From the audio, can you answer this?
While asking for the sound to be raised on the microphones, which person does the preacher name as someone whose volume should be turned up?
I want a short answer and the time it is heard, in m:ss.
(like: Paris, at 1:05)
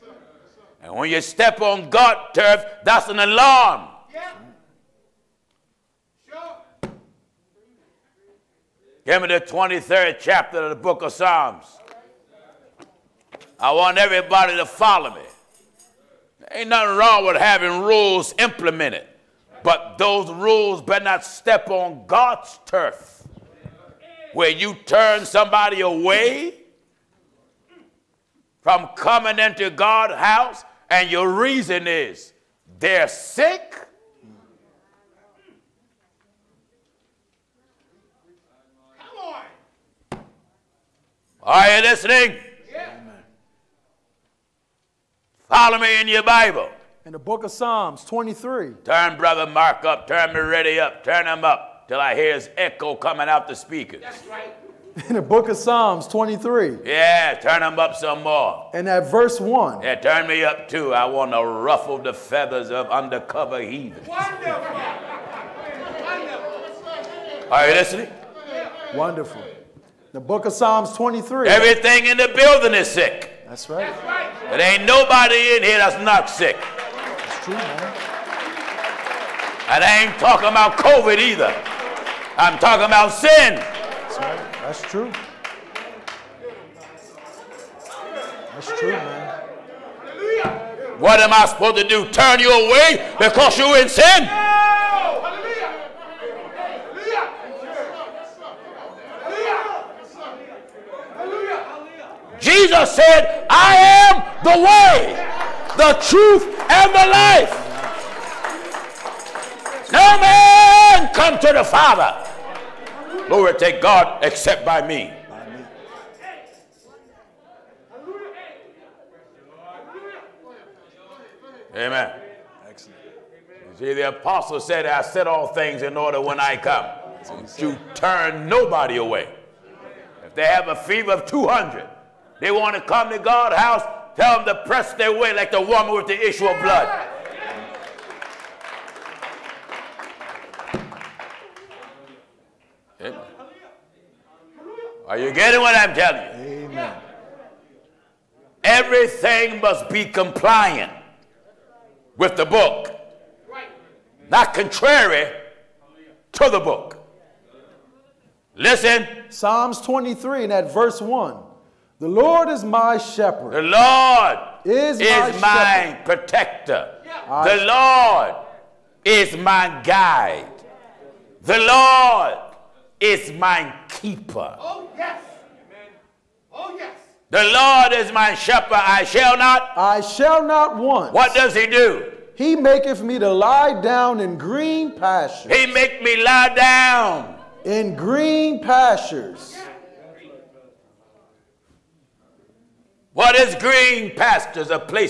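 Brother Mark, at 0:49.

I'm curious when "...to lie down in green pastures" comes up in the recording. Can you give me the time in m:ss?
3:03.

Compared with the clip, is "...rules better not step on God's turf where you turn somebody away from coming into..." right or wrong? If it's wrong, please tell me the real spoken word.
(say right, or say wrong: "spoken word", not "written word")
right.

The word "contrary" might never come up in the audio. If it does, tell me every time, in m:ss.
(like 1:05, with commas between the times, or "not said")
2:34.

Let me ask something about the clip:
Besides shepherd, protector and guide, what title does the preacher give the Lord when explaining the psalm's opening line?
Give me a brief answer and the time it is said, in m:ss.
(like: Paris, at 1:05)
keeper, at 2:53.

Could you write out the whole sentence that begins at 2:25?
Are you getting what I'm telling you?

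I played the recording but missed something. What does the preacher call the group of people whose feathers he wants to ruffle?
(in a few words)
undercover heathens.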